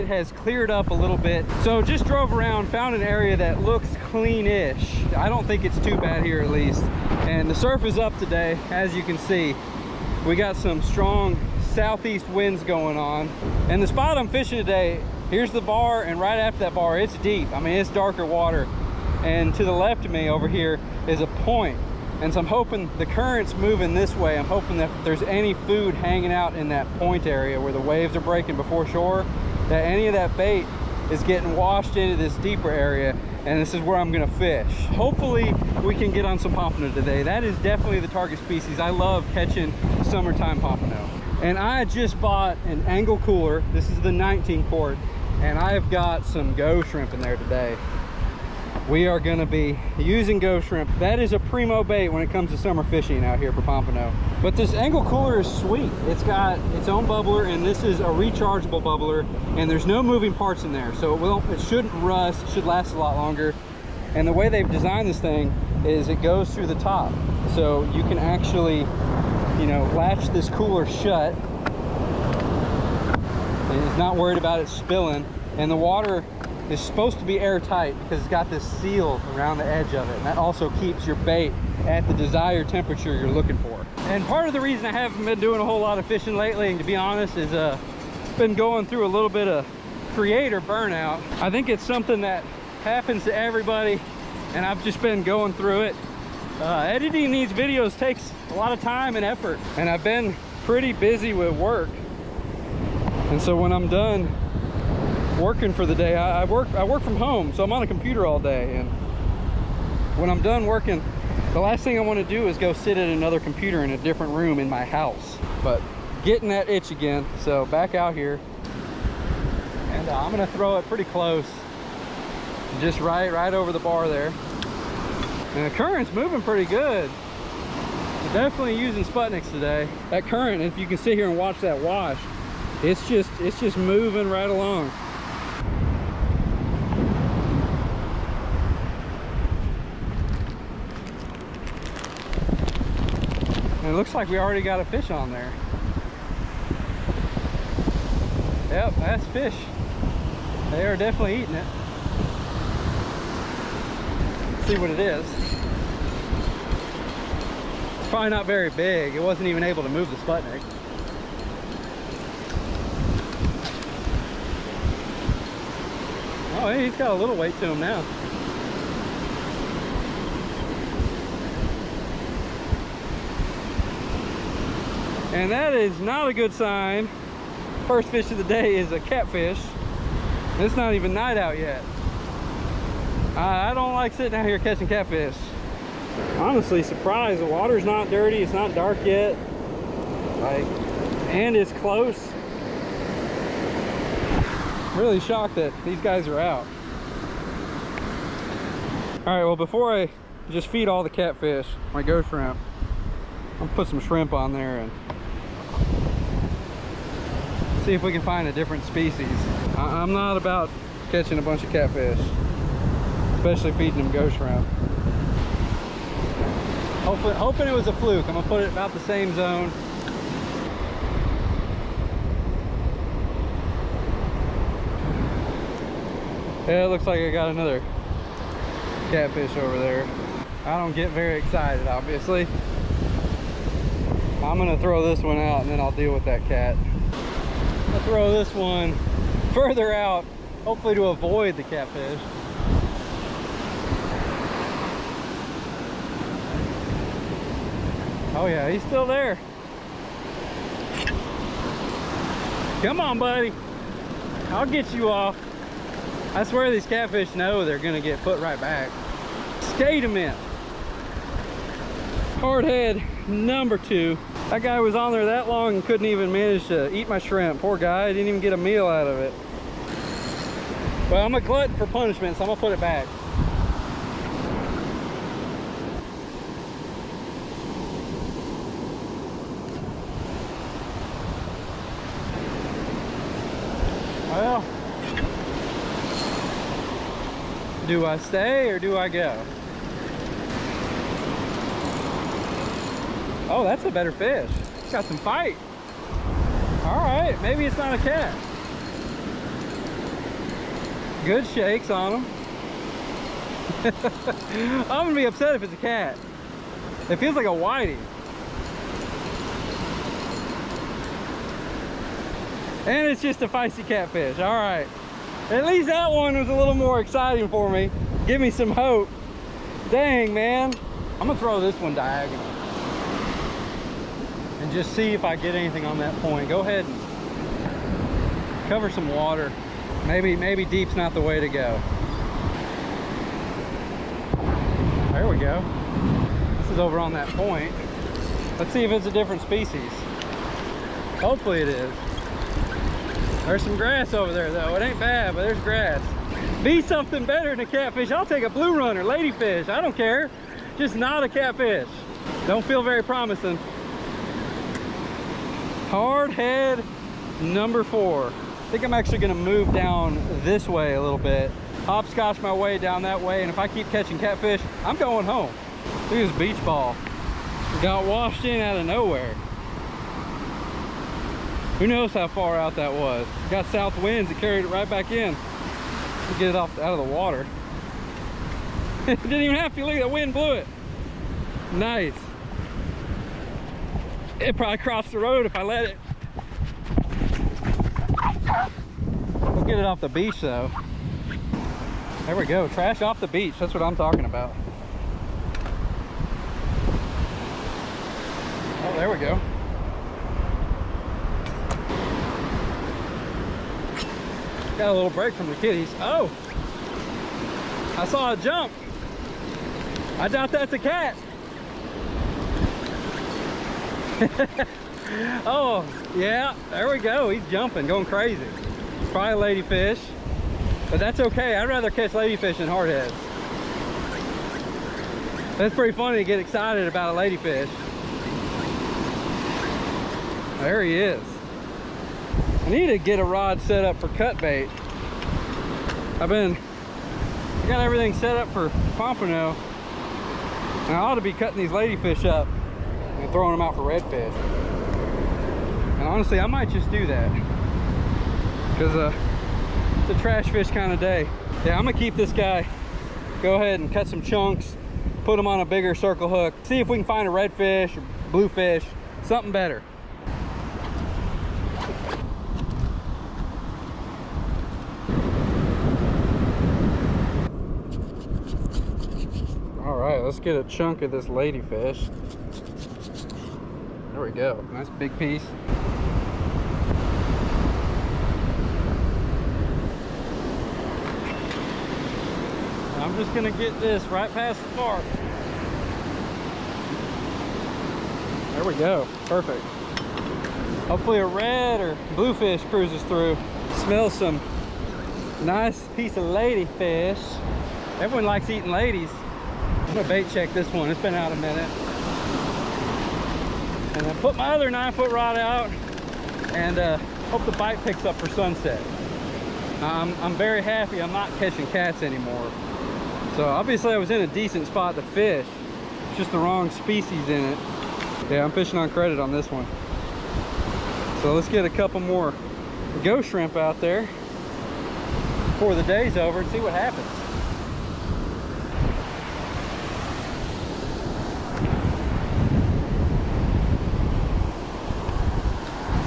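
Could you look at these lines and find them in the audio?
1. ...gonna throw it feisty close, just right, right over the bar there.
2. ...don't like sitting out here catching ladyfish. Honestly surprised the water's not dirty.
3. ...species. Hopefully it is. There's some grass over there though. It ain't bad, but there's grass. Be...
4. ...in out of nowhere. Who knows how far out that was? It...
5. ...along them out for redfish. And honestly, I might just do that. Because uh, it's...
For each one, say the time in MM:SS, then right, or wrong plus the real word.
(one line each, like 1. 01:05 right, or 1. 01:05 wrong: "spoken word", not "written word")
1. 02:00 wrong: "pretty", not "feisty"
2. 03:03 wrong: "catfish", not "ladyfish"
3. 05:39 right
4. 06:08 right
5. 07:23 wrong: "throwing", not "along".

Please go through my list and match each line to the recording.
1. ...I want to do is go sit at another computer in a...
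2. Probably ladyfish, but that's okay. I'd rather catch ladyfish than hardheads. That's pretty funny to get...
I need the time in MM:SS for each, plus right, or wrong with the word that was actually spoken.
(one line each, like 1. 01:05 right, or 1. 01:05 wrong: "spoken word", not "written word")
1. 01:51 right
2. 06:59 right.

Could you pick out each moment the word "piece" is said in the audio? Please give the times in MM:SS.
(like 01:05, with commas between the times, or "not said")
07:55, 08:15.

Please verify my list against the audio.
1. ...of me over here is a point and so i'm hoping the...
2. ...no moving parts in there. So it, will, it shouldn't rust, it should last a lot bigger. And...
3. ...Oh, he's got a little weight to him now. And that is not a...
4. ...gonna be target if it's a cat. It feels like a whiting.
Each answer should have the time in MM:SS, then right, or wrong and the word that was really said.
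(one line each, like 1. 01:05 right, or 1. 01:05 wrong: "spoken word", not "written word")
1. 00:20 right
2. 00:59 wrong: "longer", not "bigger"
3. 02:46 right
4. 05:05 wrong: "upset", not "target".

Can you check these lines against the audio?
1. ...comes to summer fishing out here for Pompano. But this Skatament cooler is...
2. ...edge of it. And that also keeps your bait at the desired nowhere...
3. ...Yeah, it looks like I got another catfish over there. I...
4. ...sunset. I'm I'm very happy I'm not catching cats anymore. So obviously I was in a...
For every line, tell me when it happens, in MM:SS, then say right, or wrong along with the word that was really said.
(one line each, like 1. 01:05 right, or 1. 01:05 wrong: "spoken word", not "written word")
1. 00:52 wrong: "Engel", not "Skatament"
2. 01:19 wrong: "temperature", not "nowhere"
3. 03:46 right
4. 08:28 right.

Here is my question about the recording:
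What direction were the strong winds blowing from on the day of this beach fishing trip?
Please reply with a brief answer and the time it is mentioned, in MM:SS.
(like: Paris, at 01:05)
Southeast, at 00:11.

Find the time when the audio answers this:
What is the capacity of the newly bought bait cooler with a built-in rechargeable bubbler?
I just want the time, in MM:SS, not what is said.
00:44.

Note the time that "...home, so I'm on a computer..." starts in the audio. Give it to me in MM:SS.
01:47.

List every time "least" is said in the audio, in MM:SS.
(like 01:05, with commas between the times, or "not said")
00:06, 05:15.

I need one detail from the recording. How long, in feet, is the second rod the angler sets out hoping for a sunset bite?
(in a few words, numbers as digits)
9.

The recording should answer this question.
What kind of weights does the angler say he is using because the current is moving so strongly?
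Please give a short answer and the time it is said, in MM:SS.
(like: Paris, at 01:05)
Sputniks, at 02:09.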